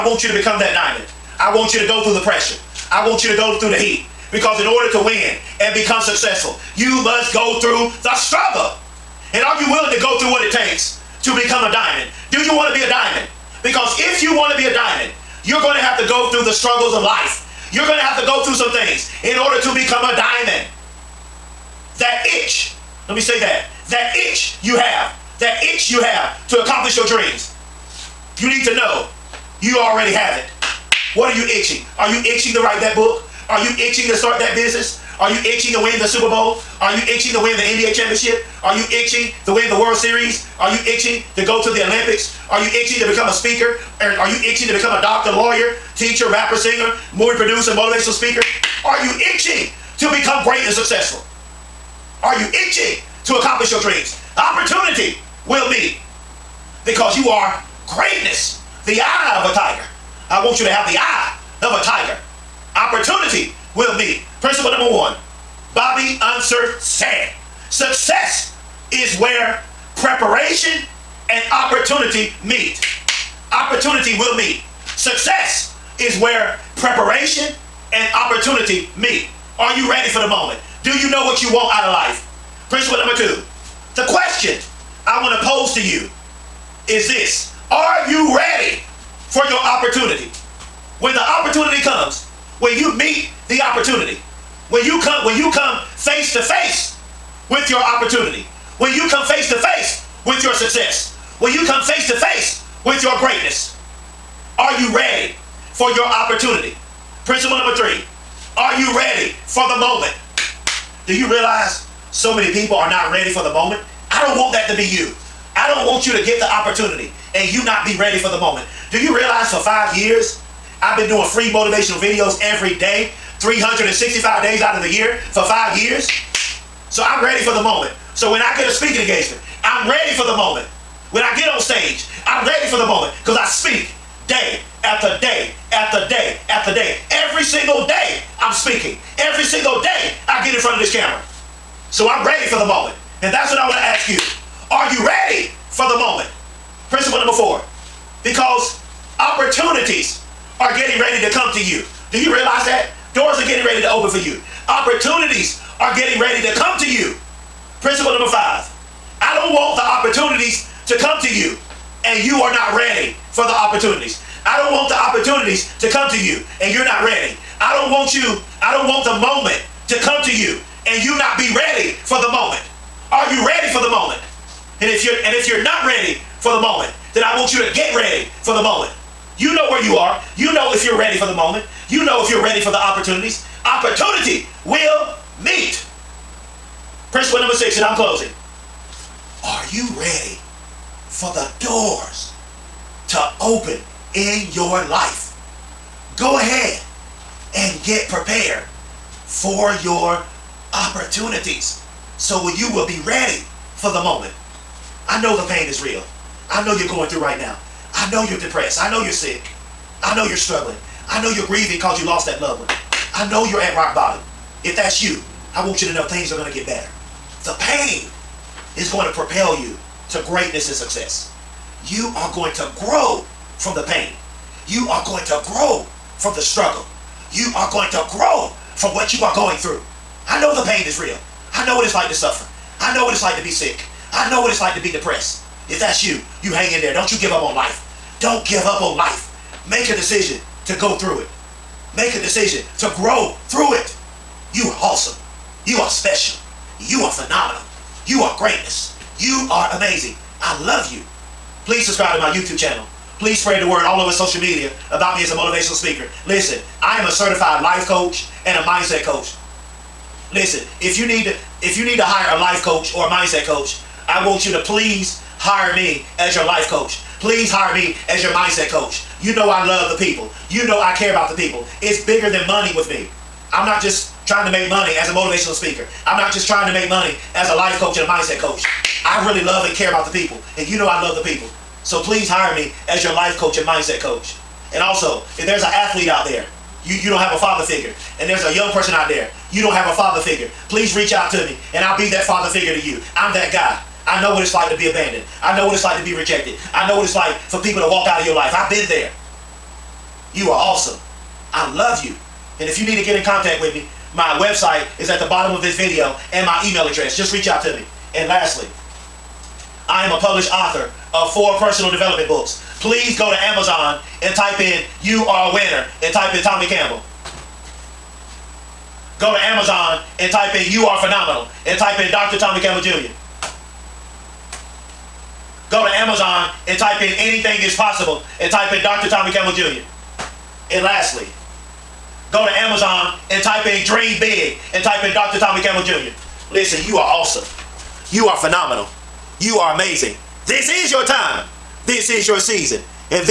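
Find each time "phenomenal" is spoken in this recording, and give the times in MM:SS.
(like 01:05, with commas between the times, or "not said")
04:07, 05:21, 05:38.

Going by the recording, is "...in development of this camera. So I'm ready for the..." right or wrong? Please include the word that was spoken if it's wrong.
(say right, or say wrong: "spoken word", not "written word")
wrong: "front", not "development".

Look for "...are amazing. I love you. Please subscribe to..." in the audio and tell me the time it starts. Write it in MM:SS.
04:09.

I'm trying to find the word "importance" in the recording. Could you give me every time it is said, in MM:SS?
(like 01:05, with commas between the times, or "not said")
not said.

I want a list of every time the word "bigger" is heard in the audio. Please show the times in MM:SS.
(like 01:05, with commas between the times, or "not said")
04:32.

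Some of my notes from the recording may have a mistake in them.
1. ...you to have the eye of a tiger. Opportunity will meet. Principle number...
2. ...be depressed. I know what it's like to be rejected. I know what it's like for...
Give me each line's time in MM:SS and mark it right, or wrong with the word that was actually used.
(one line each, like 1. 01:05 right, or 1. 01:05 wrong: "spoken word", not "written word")
1. 01:00 right
2. 04:54 wrong: "abandoned", not "depressed".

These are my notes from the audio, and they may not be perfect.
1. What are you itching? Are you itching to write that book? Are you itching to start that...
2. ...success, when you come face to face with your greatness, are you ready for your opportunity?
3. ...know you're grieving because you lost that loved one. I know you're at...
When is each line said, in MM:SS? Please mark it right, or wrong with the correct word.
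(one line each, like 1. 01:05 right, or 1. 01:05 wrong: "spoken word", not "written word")
1. 00:31 right
2. 01:40 right
3. 03:31 right.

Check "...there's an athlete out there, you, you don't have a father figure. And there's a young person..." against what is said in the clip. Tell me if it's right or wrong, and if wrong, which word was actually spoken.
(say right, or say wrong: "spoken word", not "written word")
right.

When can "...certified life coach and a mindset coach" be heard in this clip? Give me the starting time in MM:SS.
04:17.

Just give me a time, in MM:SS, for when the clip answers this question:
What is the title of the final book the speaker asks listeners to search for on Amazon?
05:33.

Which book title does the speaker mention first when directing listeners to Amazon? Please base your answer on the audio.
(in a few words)
You Are a Winner.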